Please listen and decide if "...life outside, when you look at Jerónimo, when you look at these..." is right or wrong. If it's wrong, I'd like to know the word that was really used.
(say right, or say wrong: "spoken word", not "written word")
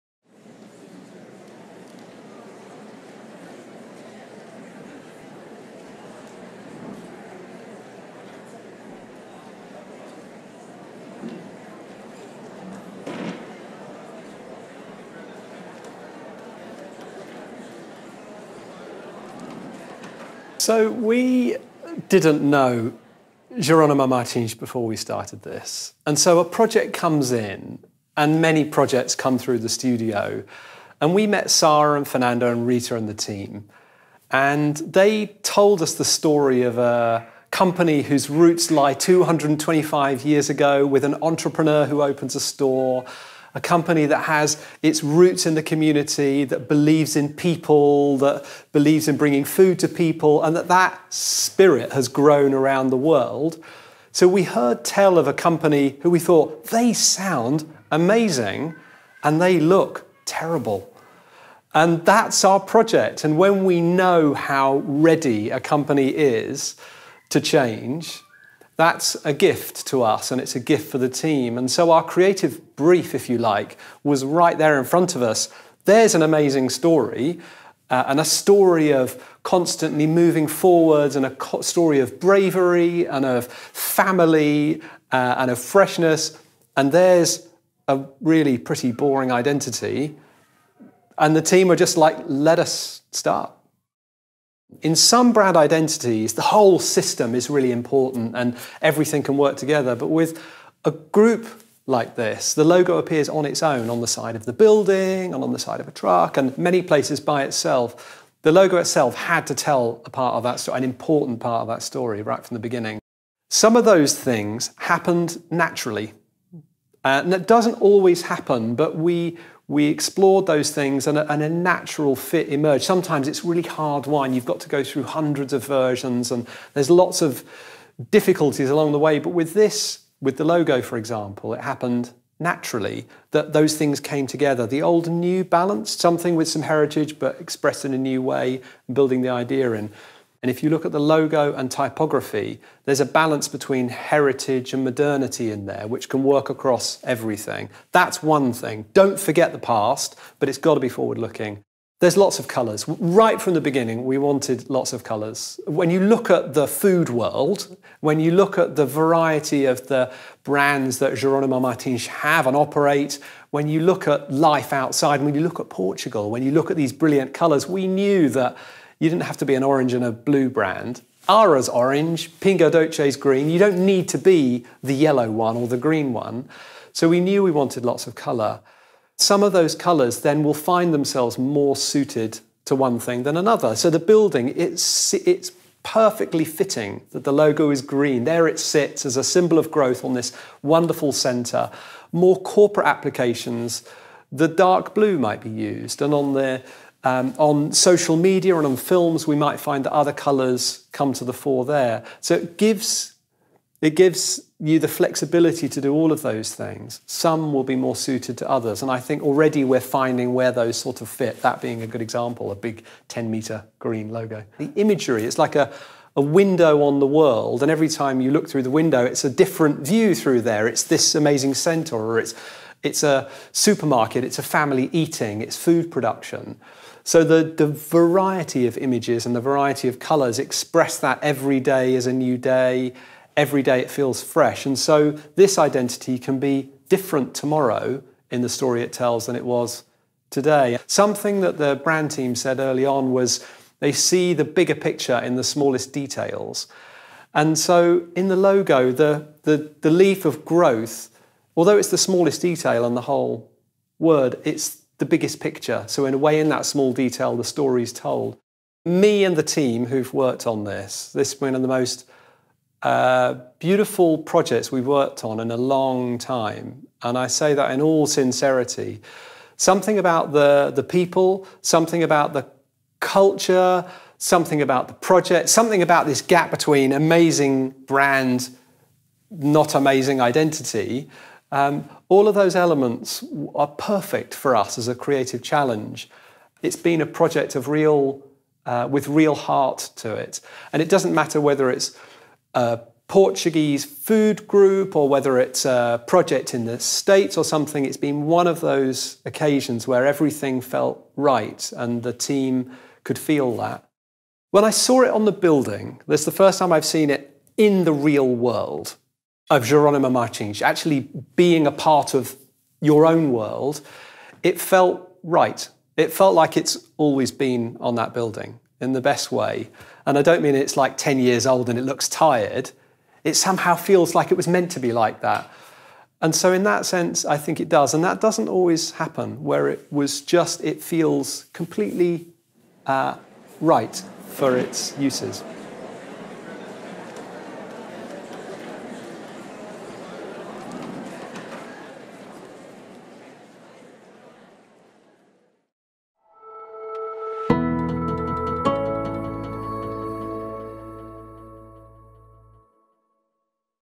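wrong: "Portugal", not "Jerónimo".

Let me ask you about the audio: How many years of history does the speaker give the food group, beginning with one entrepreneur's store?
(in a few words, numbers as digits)
225.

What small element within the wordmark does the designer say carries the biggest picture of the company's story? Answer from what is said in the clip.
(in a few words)
The leaf of growth.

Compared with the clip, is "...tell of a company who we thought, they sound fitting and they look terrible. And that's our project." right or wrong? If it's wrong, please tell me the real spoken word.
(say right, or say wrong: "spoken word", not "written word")
wrong: "amazing", not "fitting".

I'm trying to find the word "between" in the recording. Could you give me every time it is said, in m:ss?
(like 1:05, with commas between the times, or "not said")
2:23, 4:36.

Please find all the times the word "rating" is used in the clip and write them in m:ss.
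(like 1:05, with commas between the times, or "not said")
not said.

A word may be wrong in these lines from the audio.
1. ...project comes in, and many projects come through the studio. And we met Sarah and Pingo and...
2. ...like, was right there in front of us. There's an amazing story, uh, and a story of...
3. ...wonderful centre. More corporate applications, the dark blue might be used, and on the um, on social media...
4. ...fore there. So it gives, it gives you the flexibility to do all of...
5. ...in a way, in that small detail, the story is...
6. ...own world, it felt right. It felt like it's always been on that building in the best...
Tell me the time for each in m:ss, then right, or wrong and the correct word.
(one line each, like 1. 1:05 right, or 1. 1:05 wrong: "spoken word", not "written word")
1. 0:26 wrong: "Fernando", not "Pingo"
2. 1:13 right
3. 3:10 right
4. 3:21 right
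5. 4:16 right
6. 5:13 right.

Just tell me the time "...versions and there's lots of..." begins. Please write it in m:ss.
2:05.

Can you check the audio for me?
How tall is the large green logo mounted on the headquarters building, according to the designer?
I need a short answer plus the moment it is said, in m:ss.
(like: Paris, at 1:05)
10 metres, at 3:33.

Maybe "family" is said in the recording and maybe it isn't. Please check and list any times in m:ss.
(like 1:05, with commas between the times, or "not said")
1:23, 3:44.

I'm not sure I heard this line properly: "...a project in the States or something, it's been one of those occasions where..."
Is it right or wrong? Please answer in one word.
right.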